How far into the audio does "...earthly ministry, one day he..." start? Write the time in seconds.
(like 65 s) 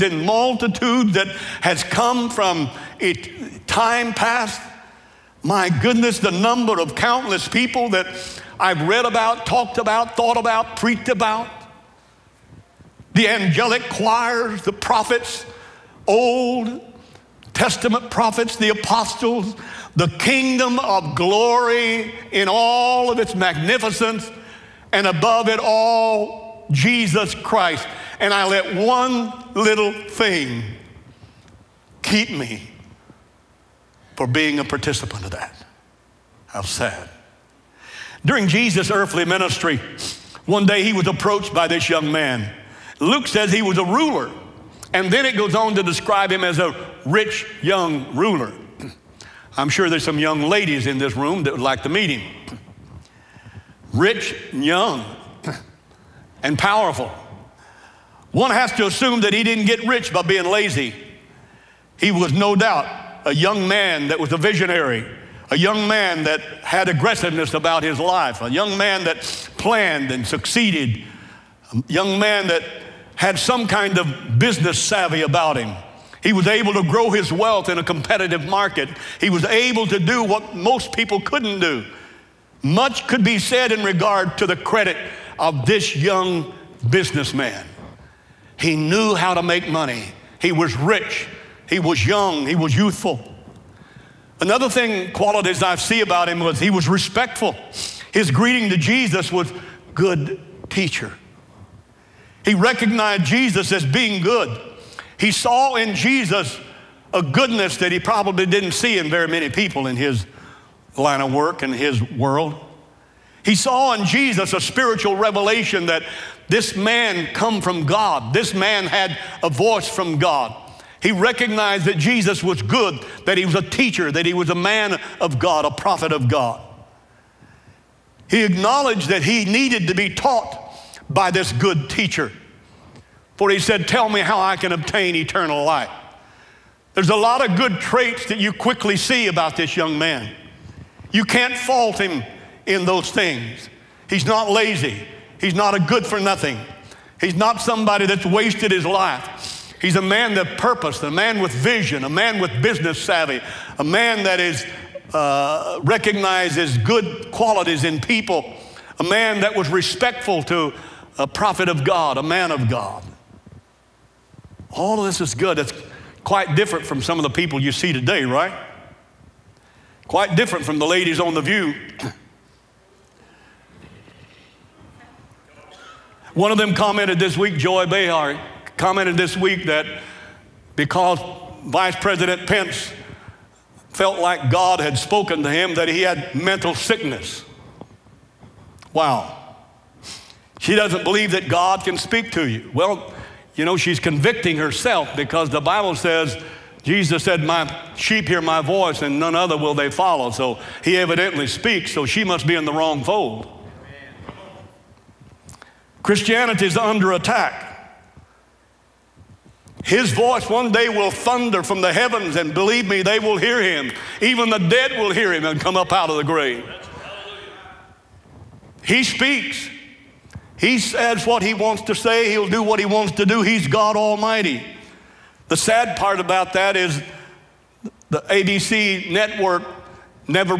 38 s.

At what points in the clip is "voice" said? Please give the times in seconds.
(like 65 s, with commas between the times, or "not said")
119 s, 198 s, 210 s.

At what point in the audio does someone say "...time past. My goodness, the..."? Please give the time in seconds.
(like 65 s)
3 s.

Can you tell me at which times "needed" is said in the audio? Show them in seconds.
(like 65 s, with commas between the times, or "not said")
129 s.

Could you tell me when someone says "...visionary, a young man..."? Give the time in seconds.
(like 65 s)
64 s.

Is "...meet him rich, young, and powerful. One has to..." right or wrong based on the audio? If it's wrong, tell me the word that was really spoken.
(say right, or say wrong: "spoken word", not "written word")
right.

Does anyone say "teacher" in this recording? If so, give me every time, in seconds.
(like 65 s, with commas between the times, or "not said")
100 s, 123 s, 131 s.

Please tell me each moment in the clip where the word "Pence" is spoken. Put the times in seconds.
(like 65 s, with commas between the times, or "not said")
182 s.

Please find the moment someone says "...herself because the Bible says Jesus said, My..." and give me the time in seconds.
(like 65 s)
194 s.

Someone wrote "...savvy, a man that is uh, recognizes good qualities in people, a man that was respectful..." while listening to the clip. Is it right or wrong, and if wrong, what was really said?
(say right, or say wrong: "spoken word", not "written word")
right.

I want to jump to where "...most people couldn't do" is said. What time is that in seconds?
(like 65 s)
80 s.